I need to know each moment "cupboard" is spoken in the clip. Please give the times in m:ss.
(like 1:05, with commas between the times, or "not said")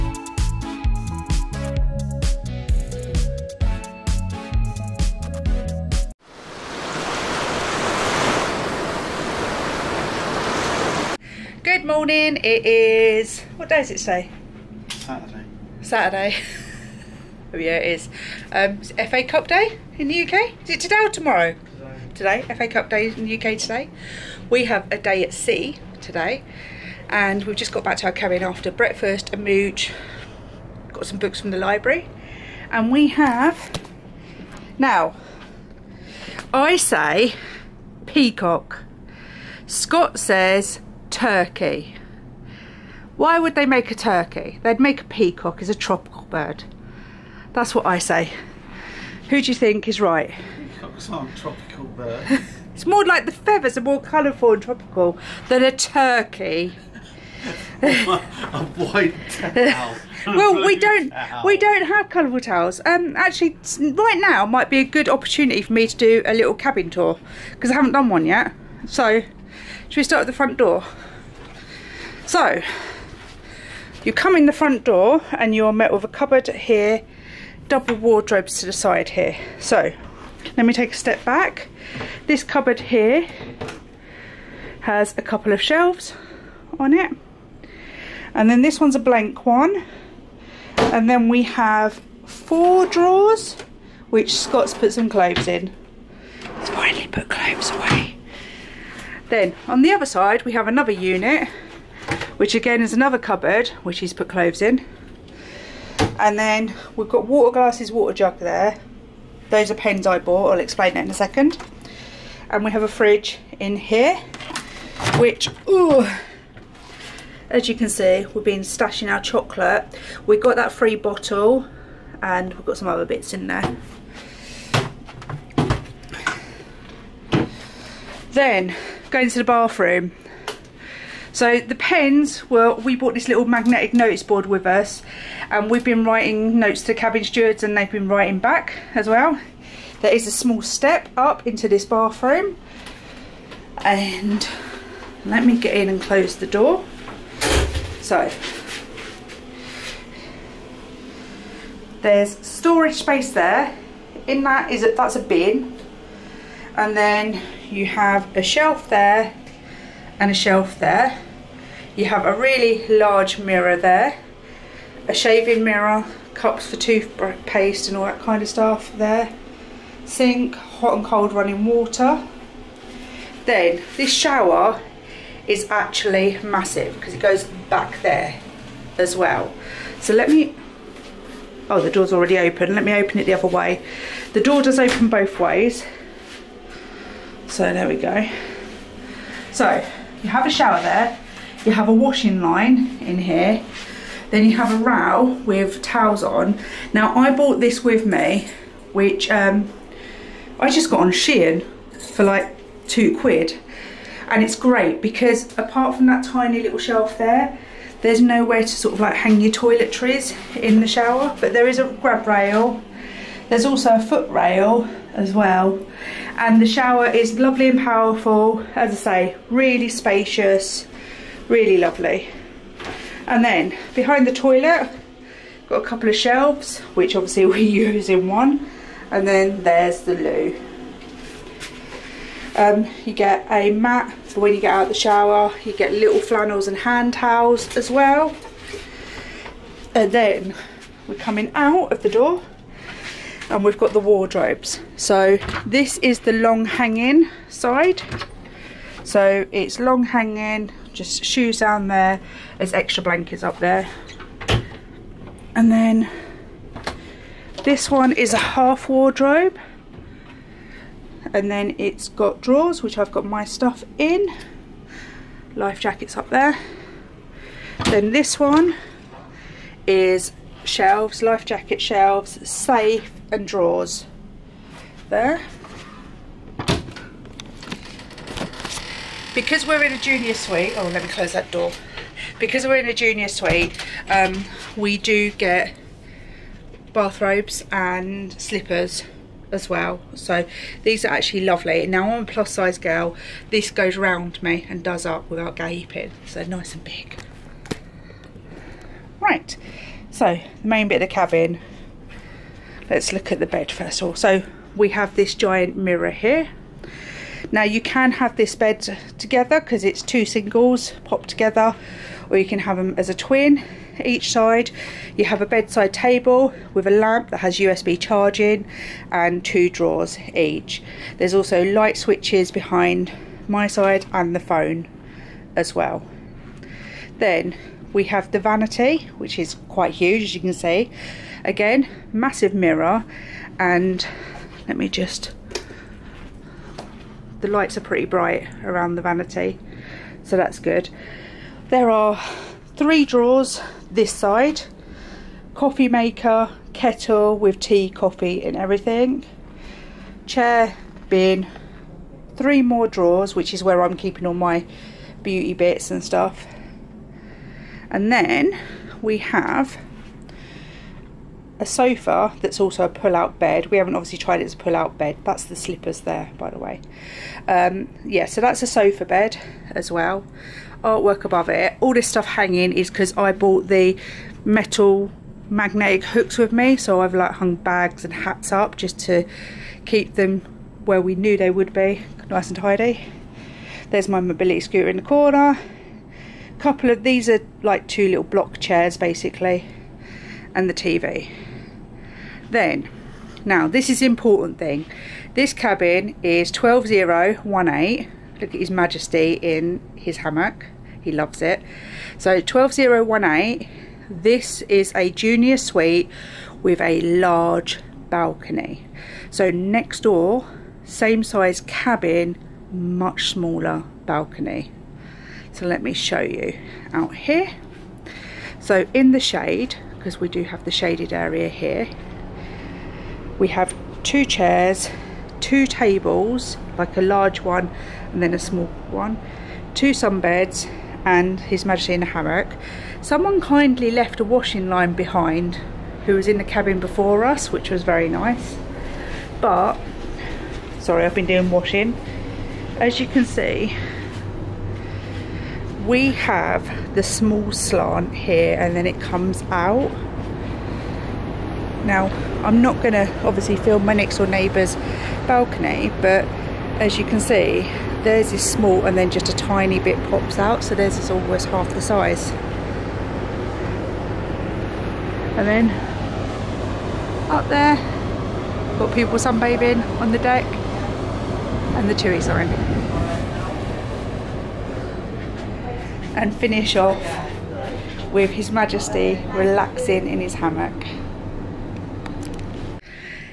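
1:16, 1:22, 1:43.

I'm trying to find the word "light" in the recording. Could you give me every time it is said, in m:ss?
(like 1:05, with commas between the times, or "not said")
5:21, 5:37.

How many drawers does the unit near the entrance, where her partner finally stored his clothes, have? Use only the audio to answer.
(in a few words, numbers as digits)
4.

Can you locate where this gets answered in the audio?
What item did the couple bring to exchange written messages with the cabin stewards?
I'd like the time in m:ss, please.
2:13.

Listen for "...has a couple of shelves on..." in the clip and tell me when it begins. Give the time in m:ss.
1:24.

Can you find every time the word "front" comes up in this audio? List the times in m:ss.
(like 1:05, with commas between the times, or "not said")
1:10, 1:14.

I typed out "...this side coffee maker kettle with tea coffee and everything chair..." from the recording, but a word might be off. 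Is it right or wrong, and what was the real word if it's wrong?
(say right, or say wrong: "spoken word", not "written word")
right.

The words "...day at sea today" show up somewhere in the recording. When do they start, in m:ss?
0:24.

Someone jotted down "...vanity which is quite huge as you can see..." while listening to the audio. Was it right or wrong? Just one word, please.
right.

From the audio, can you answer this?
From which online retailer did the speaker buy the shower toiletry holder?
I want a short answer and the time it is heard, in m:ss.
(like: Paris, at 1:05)
Shein, at 3:21.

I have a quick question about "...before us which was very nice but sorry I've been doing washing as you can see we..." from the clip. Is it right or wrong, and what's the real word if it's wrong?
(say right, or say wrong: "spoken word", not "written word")
right.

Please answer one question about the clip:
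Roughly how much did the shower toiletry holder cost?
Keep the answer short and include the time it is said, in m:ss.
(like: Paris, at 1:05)
2 pounds, at 3:22.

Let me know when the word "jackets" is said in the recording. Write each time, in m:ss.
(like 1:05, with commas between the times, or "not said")
4:25, 4:31.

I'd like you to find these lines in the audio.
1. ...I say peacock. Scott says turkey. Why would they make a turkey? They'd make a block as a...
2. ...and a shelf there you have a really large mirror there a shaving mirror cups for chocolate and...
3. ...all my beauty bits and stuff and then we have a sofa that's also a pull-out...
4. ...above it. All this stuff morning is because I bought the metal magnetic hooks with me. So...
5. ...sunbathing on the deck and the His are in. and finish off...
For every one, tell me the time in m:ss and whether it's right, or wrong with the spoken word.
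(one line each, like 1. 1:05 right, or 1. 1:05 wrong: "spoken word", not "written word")
1. 0:36 wrong: "peacock", not "block"
2. 2:40 wrong: "toothpaste", not "chocolate"
3. 5:54 right
4. 6:11 wrong: "hanging", not "morning"
5. 7:49 wrong: "TUIs", not "His".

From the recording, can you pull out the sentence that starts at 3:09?
So you have a shower there, you have a washing line in here, then you have a row with towels on.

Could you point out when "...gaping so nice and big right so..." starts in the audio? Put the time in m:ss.
4:55.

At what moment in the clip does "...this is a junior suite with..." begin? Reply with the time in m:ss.
6:44.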